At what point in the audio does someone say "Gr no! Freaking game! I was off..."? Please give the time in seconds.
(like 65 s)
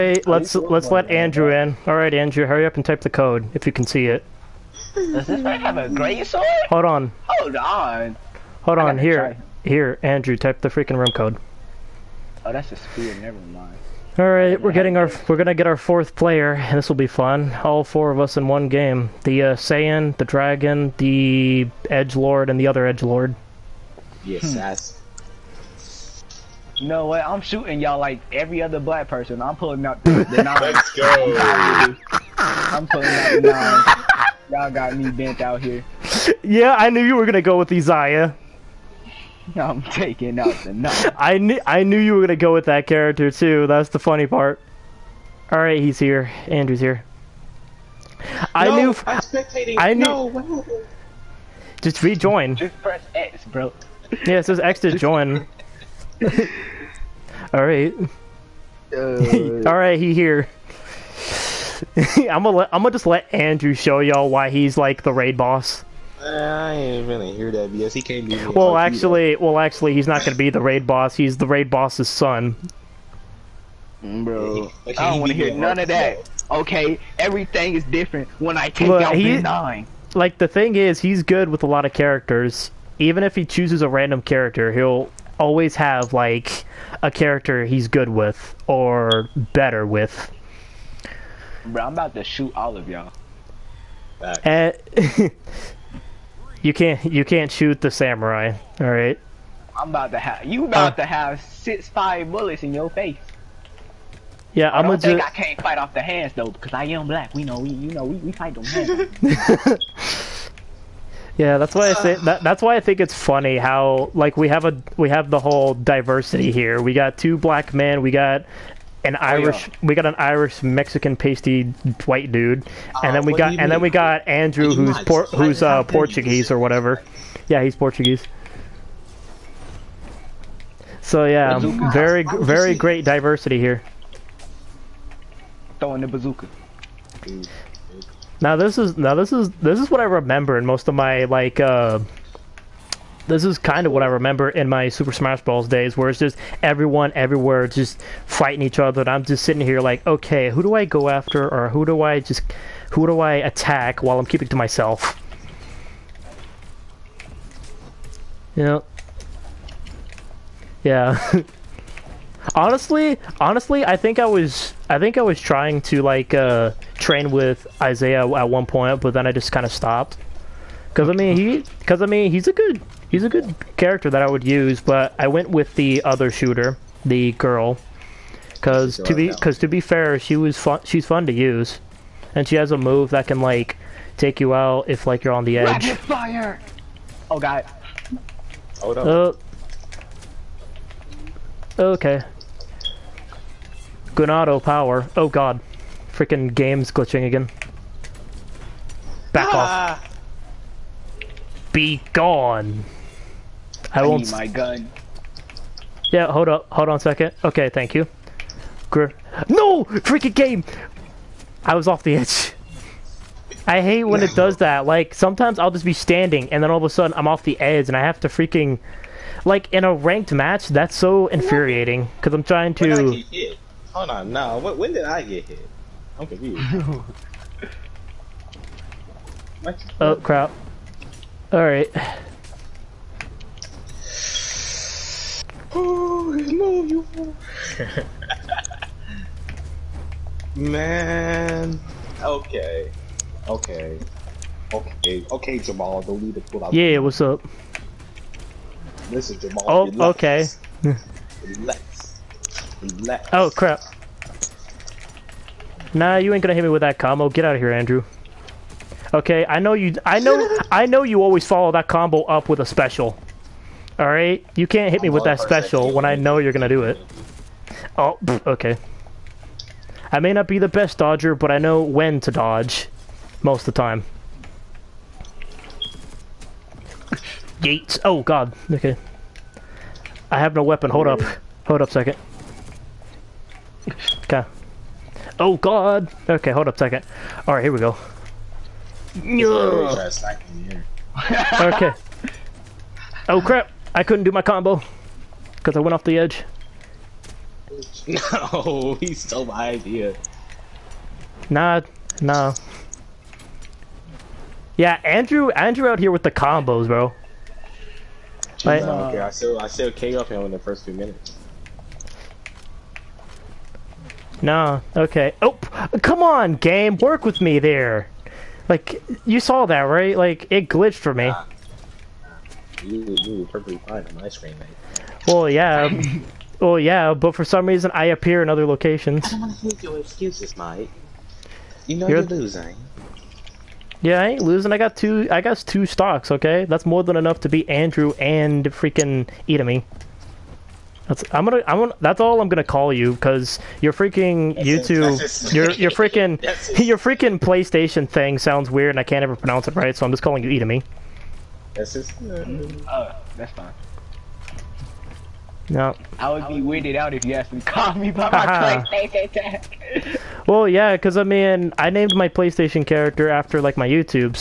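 208 s.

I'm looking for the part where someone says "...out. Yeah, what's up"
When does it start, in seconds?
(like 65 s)
246 s.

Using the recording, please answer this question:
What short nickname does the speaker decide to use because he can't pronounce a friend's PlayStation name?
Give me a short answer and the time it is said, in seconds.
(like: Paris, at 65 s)
Edami, at 350 s.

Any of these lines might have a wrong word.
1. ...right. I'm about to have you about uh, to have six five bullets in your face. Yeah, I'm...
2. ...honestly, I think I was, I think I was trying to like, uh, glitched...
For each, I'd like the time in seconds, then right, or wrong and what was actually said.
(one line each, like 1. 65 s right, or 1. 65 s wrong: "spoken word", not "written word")
1. 98 s right
2. 163 s wrong: "trained", not "glitched".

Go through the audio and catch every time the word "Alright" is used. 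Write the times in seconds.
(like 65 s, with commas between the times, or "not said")
231 s, 287 s.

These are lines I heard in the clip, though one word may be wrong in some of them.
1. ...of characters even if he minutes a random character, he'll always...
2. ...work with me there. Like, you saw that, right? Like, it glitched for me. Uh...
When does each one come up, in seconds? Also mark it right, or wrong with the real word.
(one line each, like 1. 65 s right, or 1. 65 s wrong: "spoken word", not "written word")
1. 81 s wrong: "chooses", not "minutes"
2. 316 s right.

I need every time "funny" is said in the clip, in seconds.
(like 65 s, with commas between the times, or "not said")
43 s, 113 s.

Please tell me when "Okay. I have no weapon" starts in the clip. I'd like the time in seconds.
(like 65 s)
278 s.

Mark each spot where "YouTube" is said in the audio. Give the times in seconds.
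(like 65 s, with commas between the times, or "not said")
344 s, 363 s.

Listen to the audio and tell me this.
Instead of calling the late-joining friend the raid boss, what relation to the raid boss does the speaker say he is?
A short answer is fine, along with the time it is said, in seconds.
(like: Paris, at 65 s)
the raid boss's son, at 71 s.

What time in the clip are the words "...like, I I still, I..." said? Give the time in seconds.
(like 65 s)
308 s.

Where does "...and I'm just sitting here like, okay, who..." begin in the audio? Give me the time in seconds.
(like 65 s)
149 s.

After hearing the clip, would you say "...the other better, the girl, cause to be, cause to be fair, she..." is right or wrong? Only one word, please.
wrong.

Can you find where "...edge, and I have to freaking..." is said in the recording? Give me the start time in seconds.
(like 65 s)
217 s.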